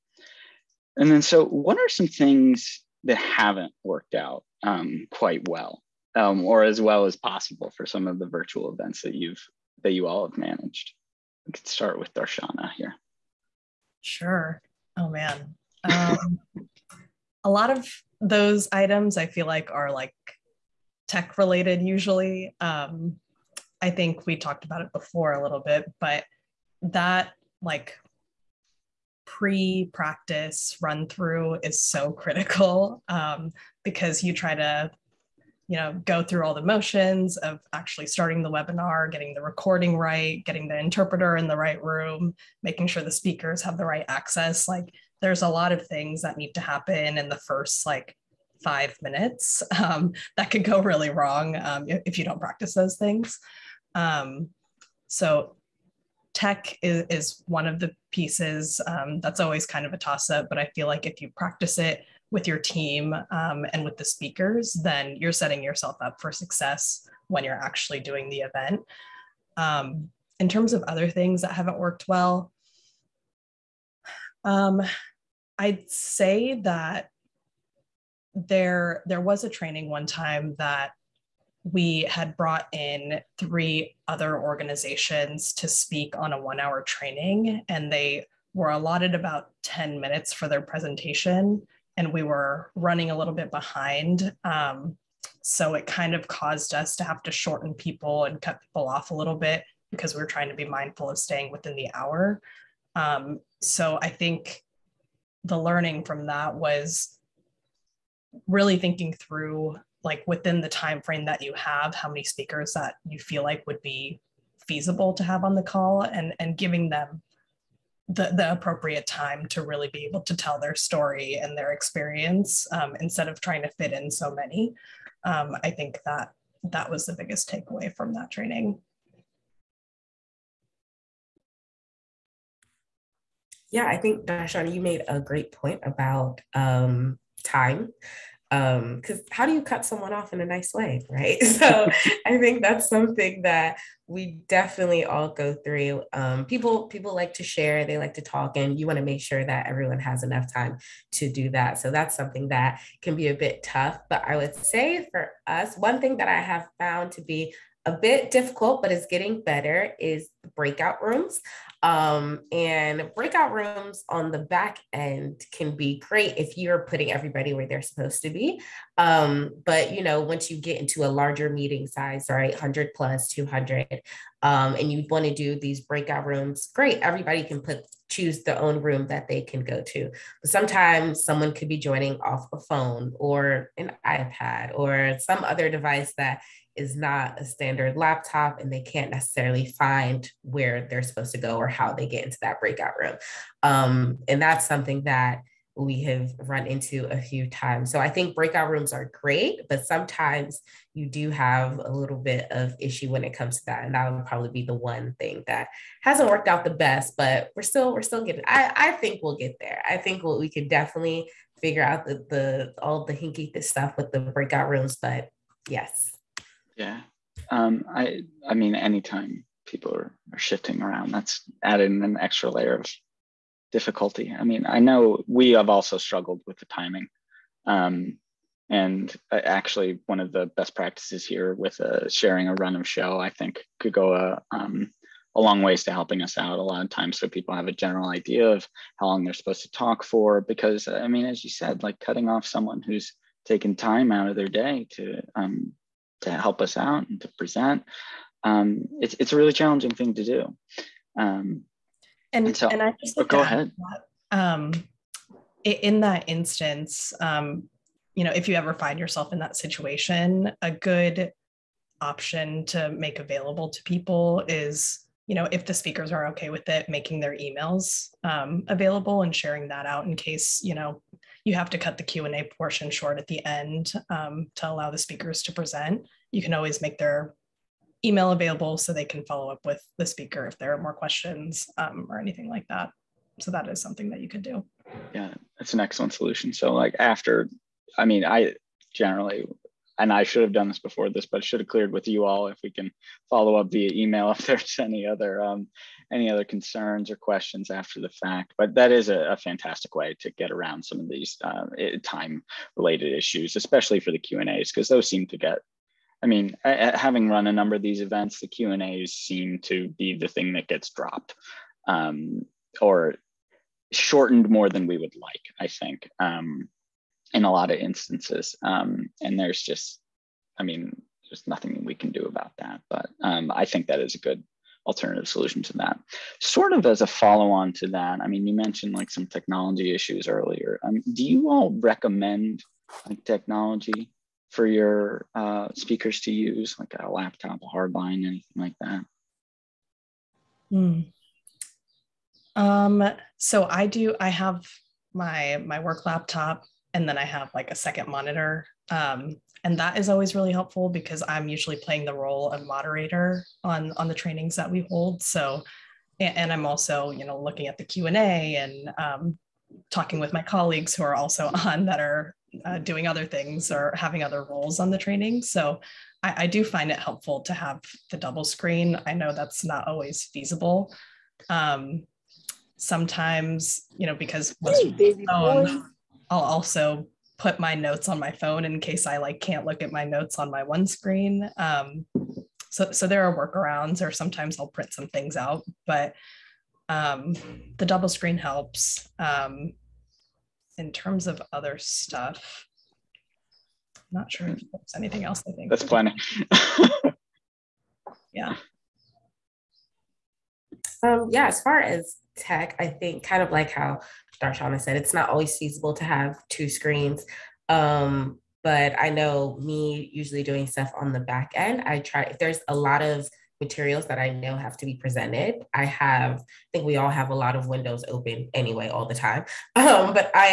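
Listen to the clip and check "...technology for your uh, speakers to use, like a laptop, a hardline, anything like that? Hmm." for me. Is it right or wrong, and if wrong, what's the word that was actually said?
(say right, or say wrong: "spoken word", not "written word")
right.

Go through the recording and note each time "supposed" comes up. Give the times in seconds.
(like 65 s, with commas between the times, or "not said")
167 s, 191 s, 239 s.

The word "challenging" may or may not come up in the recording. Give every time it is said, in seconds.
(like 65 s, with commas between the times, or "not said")
249 s.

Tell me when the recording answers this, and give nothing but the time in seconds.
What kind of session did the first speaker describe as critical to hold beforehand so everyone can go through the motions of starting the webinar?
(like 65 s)
29 s.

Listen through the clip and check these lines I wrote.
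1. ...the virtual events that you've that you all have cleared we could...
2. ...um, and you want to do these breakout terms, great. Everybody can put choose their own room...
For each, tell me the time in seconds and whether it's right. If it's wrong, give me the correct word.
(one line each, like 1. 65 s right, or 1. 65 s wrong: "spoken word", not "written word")
1. 8 s wrong: "managed", not "cleared"
2. 174 s wrong: "rooms", not "terms".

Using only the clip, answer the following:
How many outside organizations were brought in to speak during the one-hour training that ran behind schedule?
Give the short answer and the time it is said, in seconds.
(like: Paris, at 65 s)
3, at 83 s.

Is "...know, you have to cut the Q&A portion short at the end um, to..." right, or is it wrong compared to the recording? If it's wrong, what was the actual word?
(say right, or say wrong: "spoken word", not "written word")
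right.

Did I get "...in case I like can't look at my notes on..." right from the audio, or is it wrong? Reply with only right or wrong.
right.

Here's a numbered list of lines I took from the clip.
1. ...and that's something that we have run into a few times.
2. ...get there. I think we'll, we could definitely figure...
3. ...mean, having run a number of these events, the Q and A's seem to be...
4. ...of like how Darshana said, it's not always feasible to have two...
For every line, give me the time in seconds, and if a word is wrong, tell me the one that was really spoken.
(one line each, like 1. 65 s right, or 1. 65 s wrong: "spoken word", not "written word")
1. 194 s right
2. 209 s right
3. 306 s right
4. 403 s right.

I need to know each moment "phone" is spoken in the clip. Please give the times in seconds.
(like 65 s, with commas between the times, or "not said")
182 s, 378 s.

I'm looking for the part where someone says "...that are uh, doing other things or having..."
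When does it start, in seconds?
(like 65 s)
361 s.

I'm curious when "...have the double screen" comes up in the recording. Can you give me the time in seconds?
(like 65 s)
367 s.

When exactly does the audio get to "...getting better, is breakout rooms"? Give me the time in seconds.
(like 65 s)
159 s.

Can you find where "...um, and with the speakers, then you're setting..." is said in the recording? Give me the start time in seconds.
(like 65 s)
63 s.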